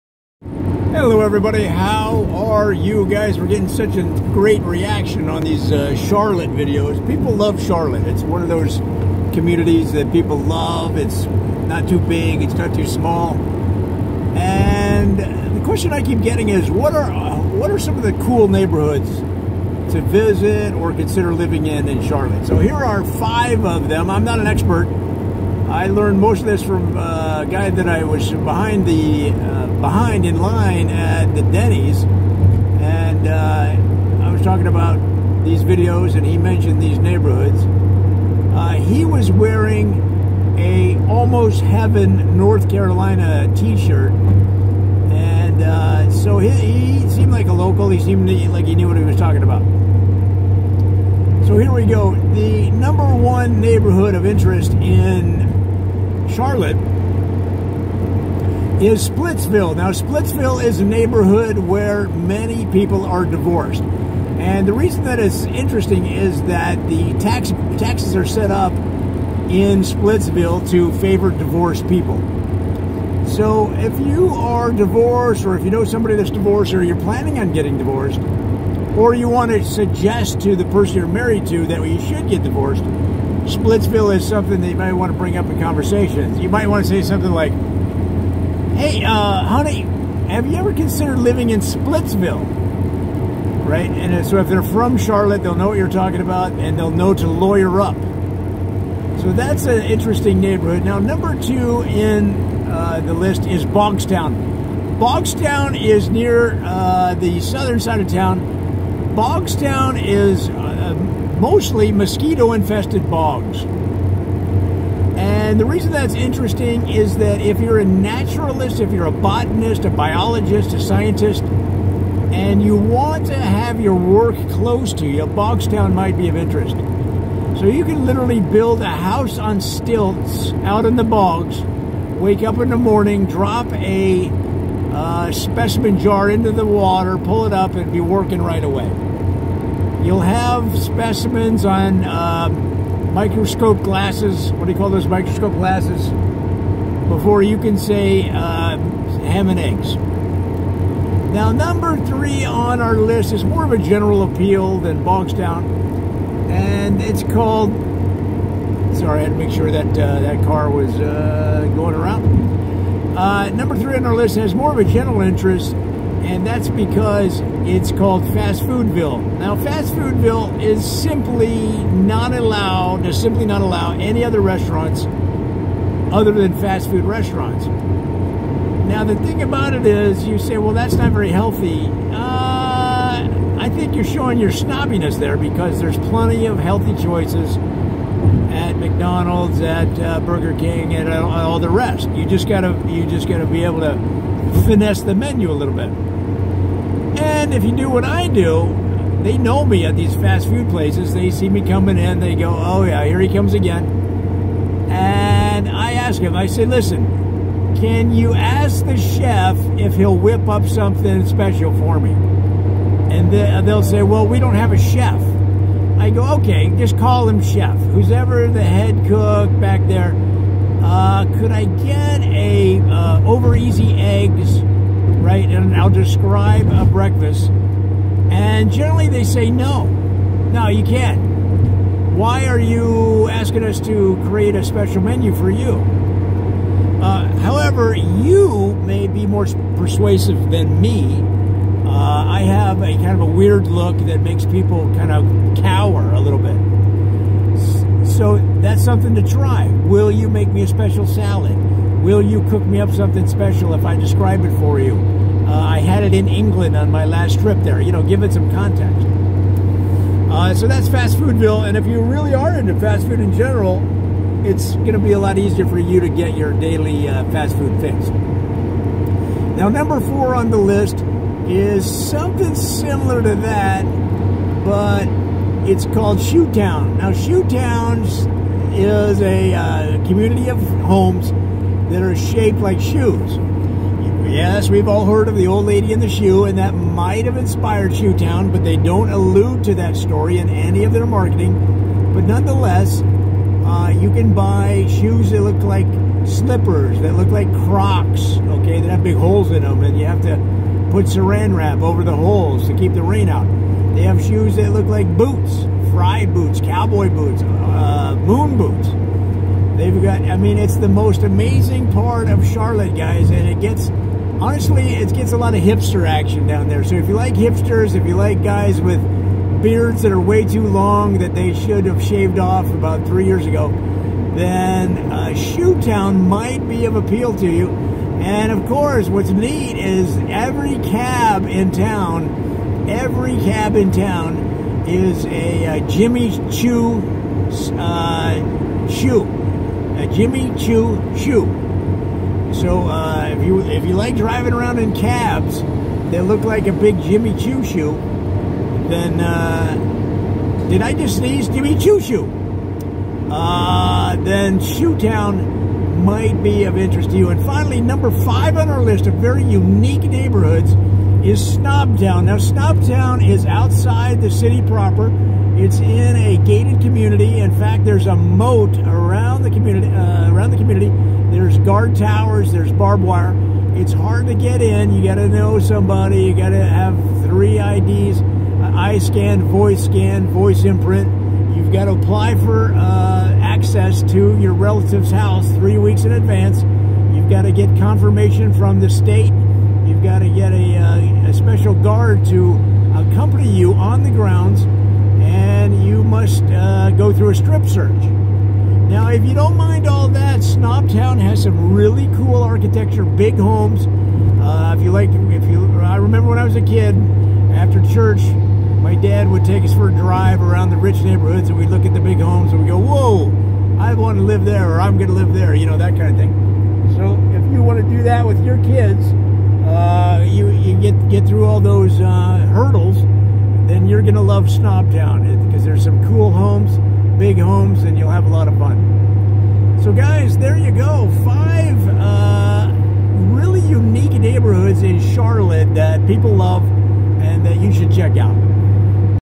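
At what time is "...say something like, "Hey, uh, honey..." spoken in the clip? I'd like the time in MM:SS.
01:26.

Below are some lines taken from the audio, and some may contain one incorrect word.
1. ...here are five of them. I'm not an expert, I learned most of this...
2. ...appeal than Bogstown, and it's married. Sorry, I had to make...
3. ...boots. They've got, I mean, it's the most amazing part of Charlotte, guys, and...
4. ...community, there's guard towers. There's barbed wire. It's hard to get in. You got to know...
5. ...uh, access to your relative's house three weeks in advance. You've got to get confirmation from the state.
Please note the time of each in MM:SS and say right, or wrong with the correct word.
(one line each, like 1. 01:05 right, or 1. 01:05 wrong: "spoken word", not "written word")
1. 00:22 right
2. 02:34 wrong: "called", not "married"
3. 05:08 right
4. 06:10 right
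5. 06:22 right.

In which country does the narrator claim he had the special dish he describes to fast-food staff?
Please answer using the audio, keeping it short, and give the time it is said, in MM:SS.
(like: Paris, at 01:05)
England, at 04:16.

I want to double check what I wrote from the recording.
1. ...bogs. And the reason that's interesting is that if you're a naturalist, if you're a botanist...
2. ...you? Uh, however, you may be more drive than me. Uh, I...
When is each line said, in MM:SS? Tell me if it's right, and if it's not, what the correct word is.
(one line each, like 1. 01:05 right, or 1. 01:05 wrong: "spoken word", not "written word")
1. 01:53 right
2. 03:55 wrong: "persuasive", not "drive".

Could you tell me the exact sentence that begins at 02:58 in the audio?
Now, the thing about it is, you say, well, that's not very healthy.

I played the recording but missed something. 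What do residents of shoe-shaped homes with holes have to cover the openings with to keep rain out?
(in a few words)
Saran wrap.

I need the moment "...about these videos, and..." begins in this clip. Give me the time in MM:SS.
00:34.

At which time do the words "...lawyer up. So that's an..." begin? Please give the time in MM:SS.
01:37.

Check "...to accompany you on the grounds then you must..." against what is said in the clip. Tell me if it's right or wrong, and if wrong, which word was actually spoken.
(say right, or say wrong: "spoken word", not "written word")
right.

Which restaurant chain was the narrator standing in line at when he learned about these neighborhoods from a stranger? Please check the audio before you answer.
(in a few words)
Denny's.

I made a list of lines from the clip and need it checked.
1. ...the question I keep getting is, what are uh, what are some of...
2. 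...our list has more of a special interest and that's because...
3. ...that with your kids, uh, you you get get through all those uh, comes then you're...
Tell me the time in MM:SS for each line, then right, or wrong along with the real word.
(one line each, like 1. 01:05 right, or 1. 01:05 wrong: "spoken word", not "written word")
1. 00:15 right
2. 02:44 wrong: "general", not "special"
3. 06:58 wrong: "hurdles", not "comes".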